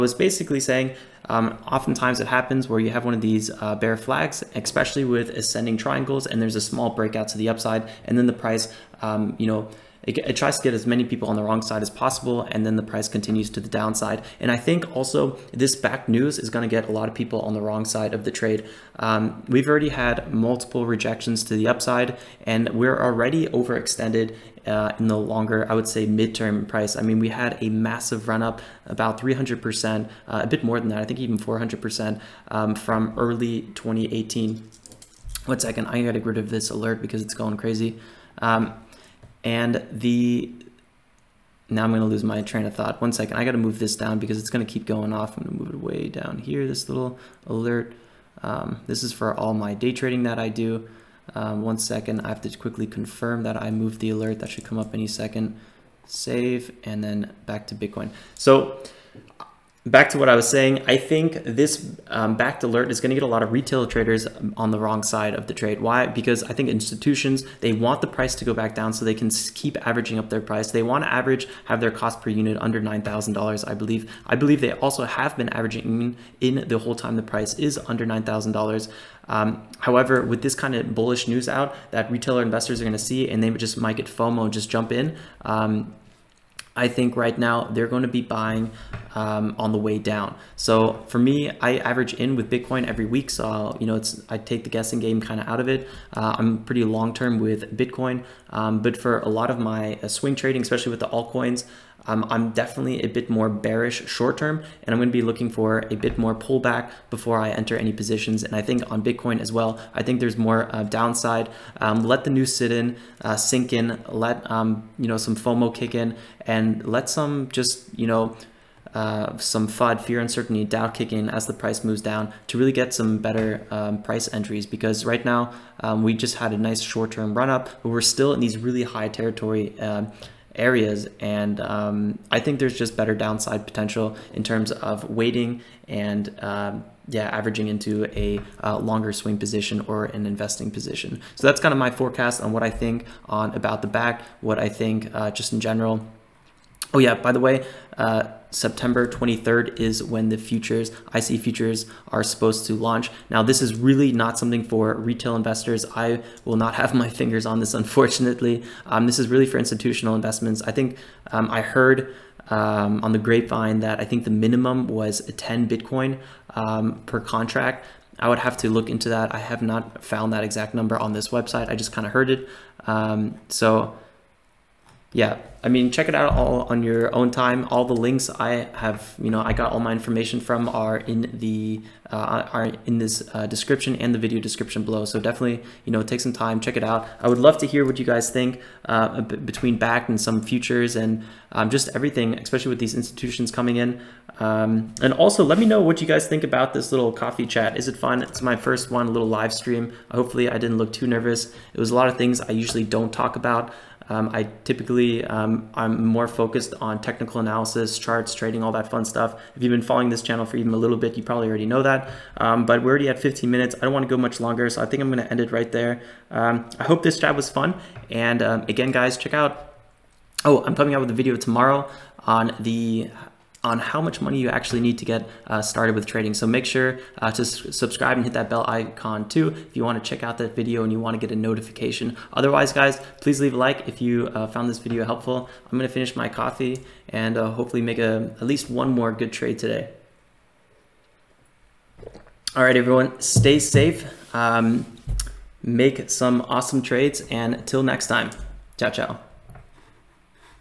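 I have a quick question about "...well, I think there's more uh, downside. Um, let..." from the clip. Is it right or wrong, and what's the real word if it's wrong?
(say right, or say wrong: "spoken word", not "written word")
right.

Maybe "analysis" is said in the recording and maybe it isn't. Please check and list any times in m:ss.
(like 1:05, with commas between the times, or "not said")
3:27.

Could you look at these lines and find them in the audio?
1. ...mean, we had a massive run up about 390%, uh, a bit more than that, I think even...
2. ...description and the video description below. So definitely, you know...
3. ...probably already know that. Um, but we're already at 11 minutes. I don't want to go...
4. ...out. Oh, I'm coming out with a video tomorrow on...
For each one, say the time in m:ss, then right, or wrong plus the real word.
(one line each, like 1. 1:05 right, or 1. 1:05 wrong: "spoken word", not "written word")
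1. 0:27 wrong: "300", not "390"
2. 3:03 right
3. 3:31 wrong: "15", not "11"
4. 3:39 right.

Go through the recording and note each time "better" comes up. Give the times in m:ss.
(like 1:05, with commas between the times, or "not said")
2:03, 2:12.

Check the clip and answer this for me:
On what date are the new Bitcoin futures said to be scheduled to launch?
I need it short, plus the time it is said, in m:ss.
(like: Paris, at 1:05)
September 23rd, at 2:28.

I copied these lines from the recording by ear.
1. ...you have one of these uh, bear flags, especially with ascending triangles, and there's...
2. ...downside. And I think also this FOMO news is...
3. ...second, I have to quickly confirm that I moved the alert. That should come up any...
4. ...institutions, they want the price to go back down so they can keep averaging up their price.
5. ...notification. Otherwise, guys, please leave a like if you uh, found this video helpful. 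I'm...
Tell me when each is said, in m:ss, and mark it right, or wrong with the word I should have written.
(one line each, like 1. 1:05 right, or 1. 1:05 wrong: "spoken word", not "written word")
1. 0:02 right
2. 0:13 wrong: "Bakkt", not "FOMO"
3. 0:51 right
4. 1:06 right
5. 3:51 right.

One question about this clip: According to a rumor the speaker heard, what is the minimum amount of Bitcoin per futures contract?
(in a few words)
10 Bitcoin.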